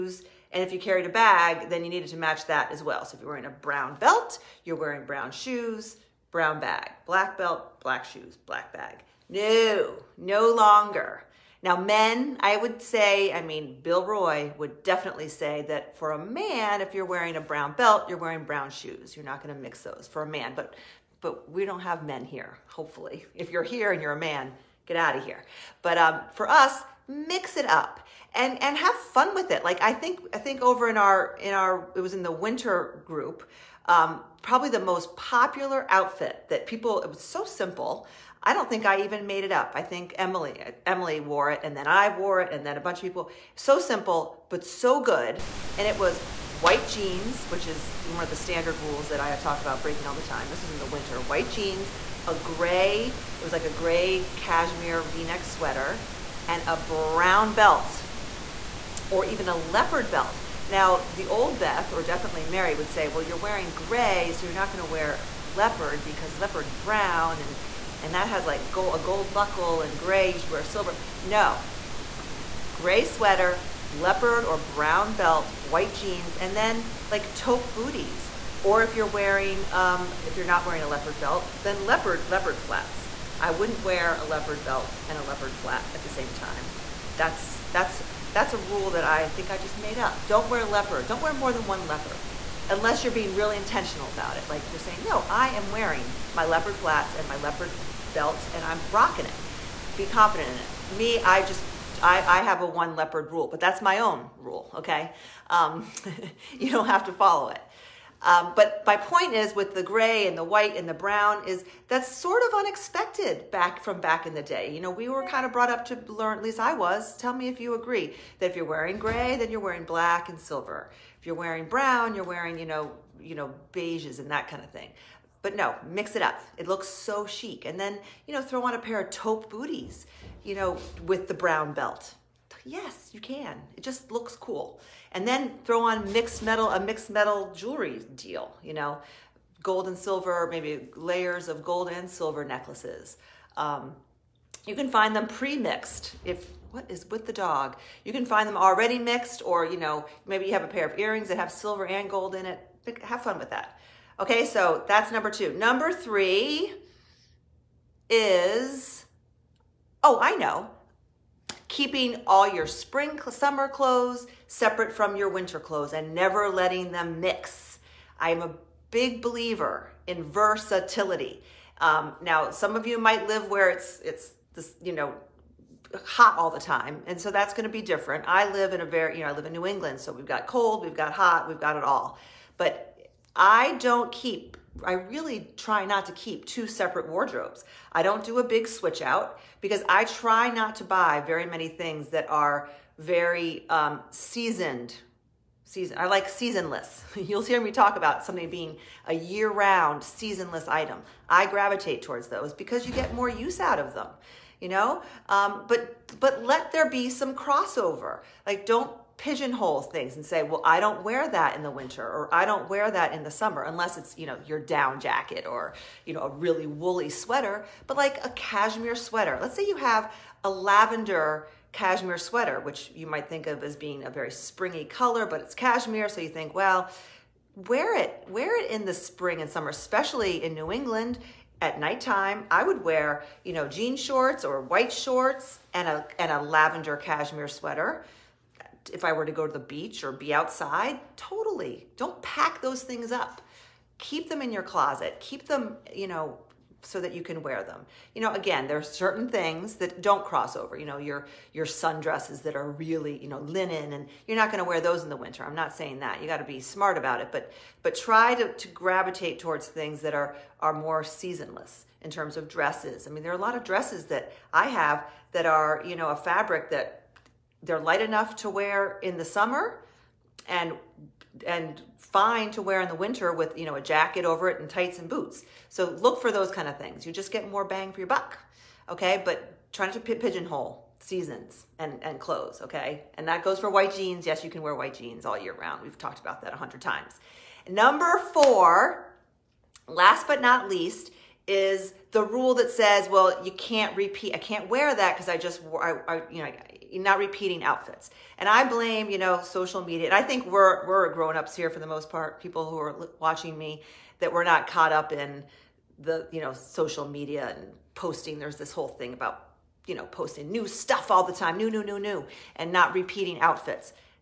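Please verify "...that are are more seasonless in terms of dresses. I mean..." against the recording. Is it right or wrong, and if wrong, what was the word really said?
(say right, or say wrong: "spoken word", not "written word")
right.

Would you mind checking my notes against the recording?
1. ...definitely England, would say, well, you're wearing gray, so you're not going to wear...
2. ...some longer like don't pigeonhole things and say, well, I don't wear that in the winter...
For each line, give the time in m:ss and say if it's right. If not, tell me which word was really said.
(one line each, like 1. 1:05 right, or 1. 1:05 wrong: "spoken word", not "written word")
1. 1:02 wrong: "Mary", not "England"
2. 3:27 wrong: "crossover", not "longer".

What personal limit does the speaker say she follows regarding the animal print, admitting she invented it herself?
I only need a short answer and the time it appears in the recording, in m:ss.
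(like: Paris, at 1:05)
one leopard rule, at 1:42.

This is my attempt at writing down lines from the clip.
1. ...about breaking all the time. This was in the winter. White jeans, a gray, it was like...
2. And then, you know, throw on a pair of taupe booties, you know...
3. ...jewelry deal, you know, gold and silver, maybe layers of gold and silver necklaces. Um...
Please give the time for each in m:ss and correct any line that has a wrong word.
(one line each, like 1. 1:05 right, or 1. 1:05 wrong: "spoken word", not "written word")
1. 0:49 right
2. 2:07 right
3. 2:17 right.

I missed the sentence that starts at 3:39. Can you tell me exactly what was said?
Let's say you have a lavender cashmere sweater, which you might think of as being a very springy color, but it's cashmere.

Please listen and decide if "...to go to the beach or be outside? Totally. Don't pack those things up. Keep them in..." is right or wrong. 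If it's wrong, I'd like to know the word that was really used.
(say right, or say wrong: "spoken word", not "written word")
right.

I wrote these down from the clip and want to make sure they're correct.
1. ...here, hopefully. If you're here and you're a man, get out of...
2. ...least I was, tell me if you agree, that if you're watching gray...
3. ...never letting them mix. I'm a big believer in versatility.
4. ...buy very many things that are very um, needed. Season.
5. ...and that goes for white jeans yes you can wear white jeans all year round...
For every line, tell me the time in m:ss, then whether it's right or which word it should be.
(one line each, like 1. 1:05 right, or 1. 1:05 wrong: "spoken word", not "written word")
1. 0:22 right
2. 1:56 wrong: "wearing", not "watching"
3. 2:46 right
4. 3:10 wrong: "seasoned", not "needed"
5. 4:43 right.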